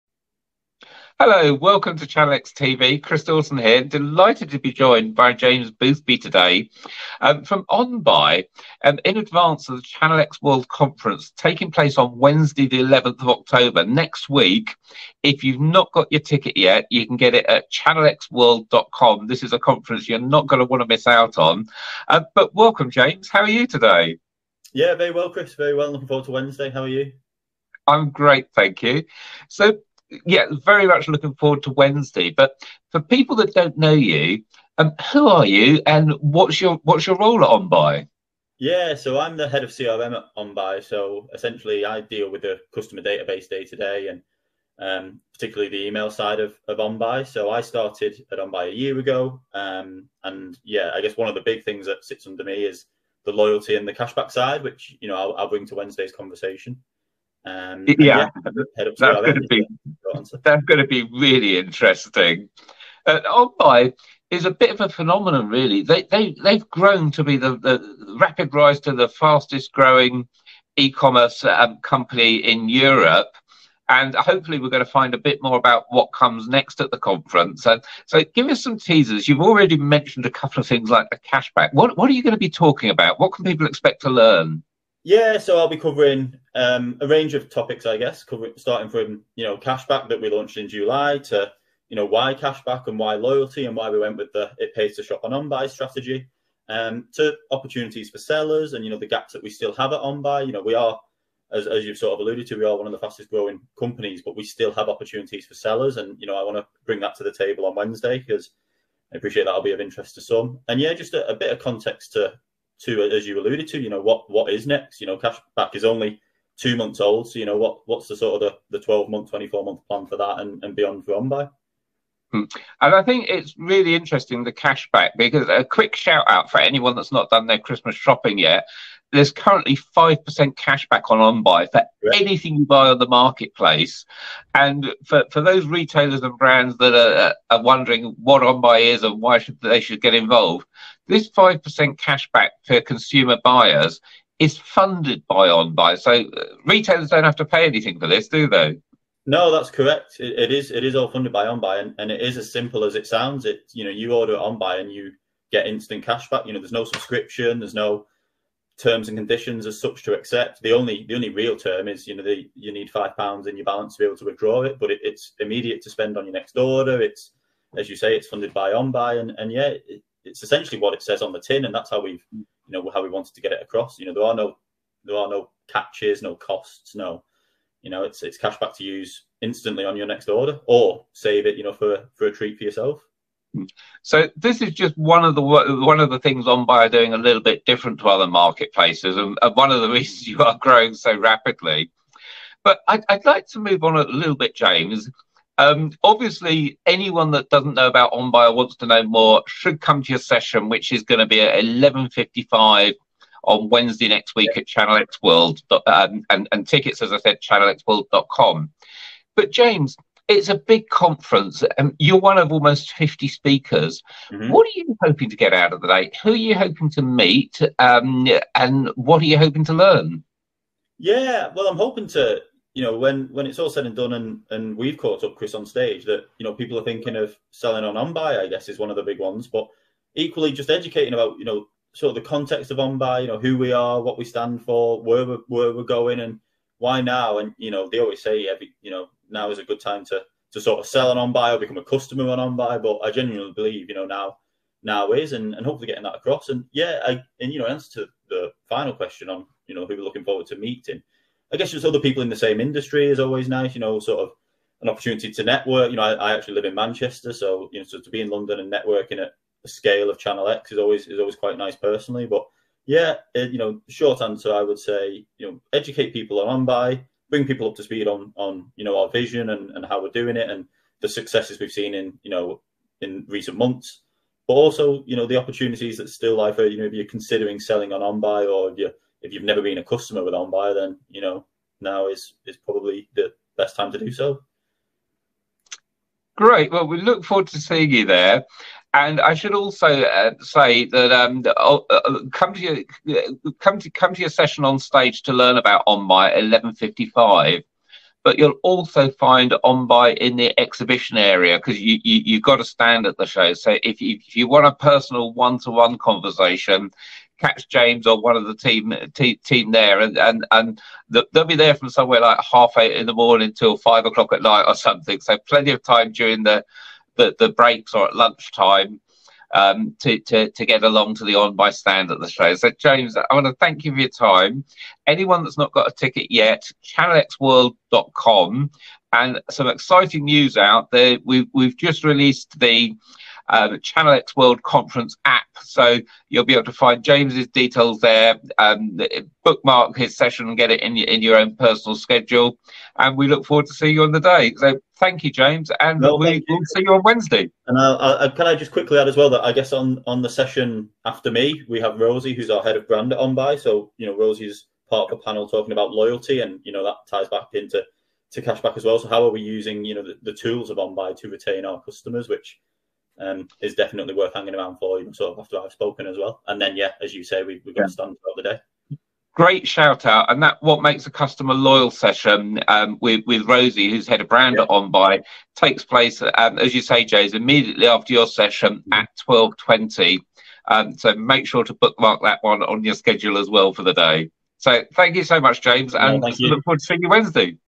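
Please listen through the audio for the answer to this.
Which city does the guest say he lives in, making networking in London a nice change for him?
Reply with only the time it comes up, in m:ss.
4:16.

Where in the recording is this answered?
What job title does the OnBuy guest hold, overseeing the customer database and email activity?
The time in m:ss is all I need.
0:39.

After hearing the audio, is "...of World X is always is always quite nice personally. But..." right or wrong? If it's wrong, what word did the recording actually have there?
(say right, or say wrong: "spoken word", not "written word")
wrong: "Channel", not "World".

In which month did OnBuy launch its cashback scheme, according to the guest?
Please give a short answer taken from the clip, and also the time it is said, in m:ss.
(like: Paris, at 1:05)
July, at 1:30.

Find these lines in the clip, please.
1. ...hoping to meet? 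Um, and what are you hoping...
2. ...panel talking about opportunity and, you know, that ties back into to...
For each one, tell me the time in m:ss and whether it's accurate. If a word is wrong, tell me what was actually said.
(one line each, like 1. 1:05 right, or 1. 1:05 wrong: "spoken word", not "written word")
1. 3:36 right
2. 5:55 wrong: "loyalty", not "opportunity".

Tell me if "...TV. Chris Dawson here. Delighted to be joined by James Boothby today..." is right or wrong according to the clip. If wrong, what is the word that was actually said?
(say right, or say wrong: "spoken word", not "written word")
right.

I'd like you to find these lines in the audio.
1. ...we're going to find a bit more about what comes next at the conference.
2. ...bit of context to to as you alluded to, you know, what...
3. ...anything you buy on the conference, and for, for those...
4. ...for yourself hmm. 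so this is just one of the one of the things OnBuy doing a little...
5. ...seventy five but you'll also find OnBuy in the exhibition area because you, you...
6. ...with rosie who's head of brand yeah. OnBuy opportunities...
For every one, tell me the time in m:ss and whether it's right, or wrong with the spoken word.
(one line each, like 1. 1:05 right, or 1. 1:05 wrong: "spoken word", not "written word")
1. 1:14 right
2. 1:51 right
3. 2:12 wrong: "marketplace", not "conference"
4. 3:02 right
5. 4:56 wrong: "fifty", not "seventy"
6. 6:13 wrong: "takes", not "opportunities".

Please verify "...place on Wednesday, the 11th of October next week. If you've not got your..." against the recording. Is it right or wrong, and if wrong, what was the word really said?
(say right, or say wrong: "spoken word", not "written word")
right.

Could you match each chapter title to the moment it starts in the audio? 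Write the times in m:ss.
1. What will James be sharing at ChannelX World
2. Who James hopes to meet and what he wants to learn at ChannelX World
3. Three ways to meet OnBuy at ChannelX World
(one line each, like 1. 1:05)
1. 1:24
2. 3:40
3. 4:46.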